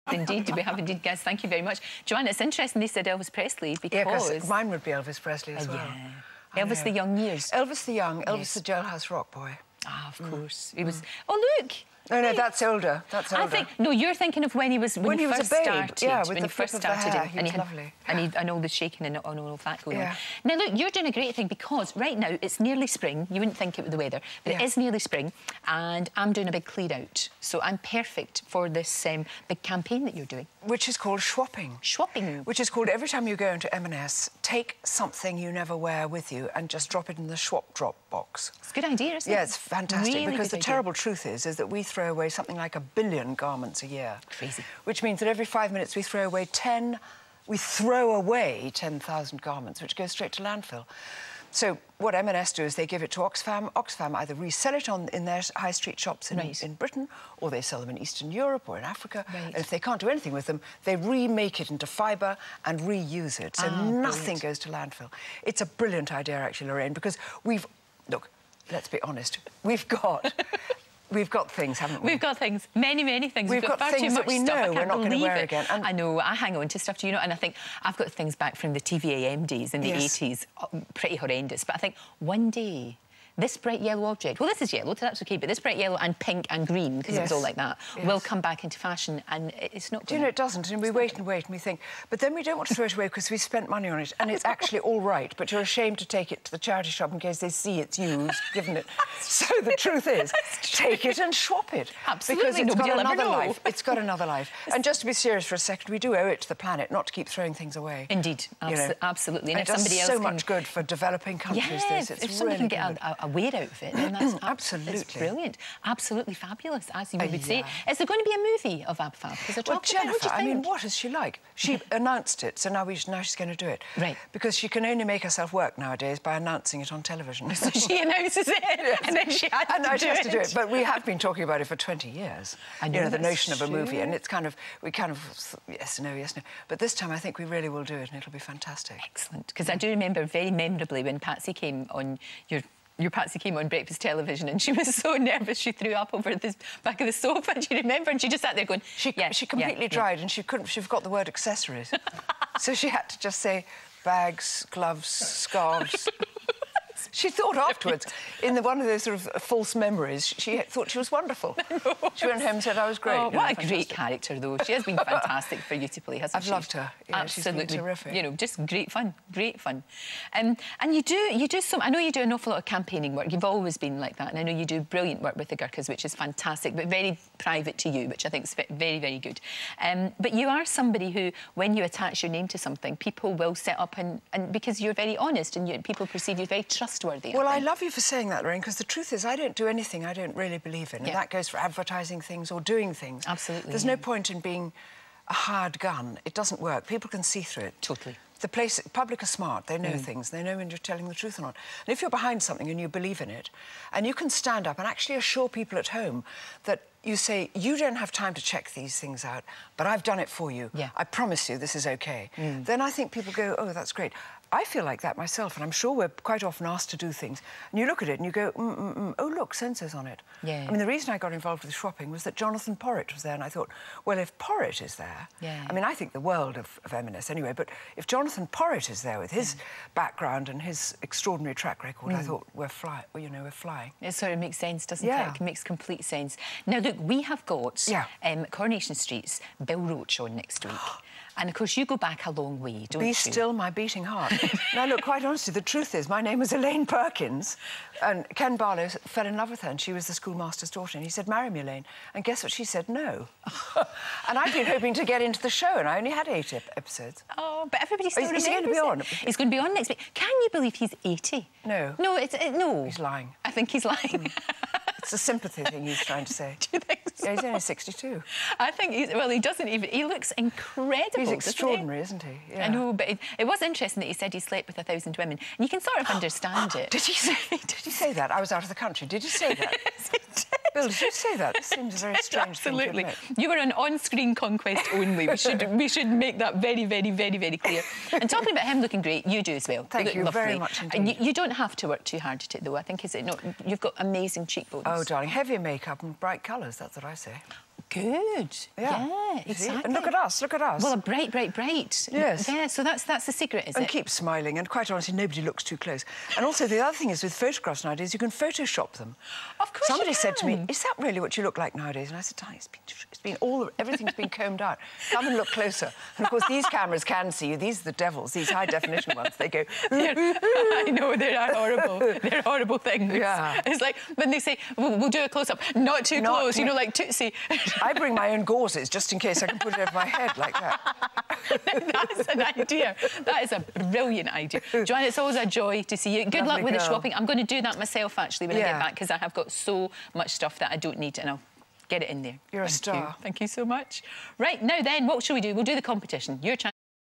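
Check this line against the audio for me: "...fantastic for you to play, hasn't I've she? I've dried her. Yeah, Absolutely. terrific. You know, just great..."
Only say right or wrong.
wrong.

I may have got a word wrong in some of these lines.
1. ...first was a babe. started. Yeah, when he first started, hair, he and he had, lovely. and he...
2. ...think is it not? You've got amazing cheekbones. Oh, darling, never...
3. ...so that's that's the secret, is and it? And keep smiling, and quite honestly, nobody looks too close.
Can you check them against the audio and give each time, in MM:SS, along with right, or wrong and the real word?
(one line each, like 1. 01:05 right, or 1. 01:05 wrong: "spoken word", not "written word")
1. 00:15 right
2. 04:52 wrong: "heavier", not "never"
3. 05:02 right.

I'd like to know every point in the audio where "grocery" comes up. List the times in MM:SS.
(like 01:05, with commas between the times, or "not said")
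not said.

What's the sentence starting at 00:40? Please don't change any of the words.
terrible truth is is that we throw away something like a billion garments a year.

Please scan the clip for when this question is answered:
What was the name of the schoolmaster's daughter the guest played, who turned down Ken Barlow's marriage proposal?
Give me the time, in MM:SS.
04:06.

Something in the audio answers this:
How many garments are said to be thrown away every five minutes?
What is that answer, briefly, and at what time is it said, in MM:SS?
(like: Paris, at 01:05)
10,000, at 00:48.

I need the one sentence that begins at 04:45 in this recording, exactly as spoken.
We should we should make that very, very, very, very clear.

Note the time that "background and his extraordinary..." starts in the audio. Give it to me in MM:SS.
03:49.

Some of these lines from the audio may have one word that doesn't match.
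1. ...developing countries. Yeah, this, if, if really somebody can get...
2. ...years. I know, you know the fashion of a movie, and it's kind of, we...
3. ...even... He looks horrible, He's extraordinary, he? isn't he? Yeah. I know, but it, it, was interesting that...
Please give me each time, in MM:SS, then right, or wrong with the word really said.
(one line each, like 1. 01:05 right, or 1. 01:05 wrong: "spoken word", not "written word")
1. 01:50 right
2. 02:12 wrong: "notion", not "fashion"
3. 04:29 wrong: "incredible", not "horrible".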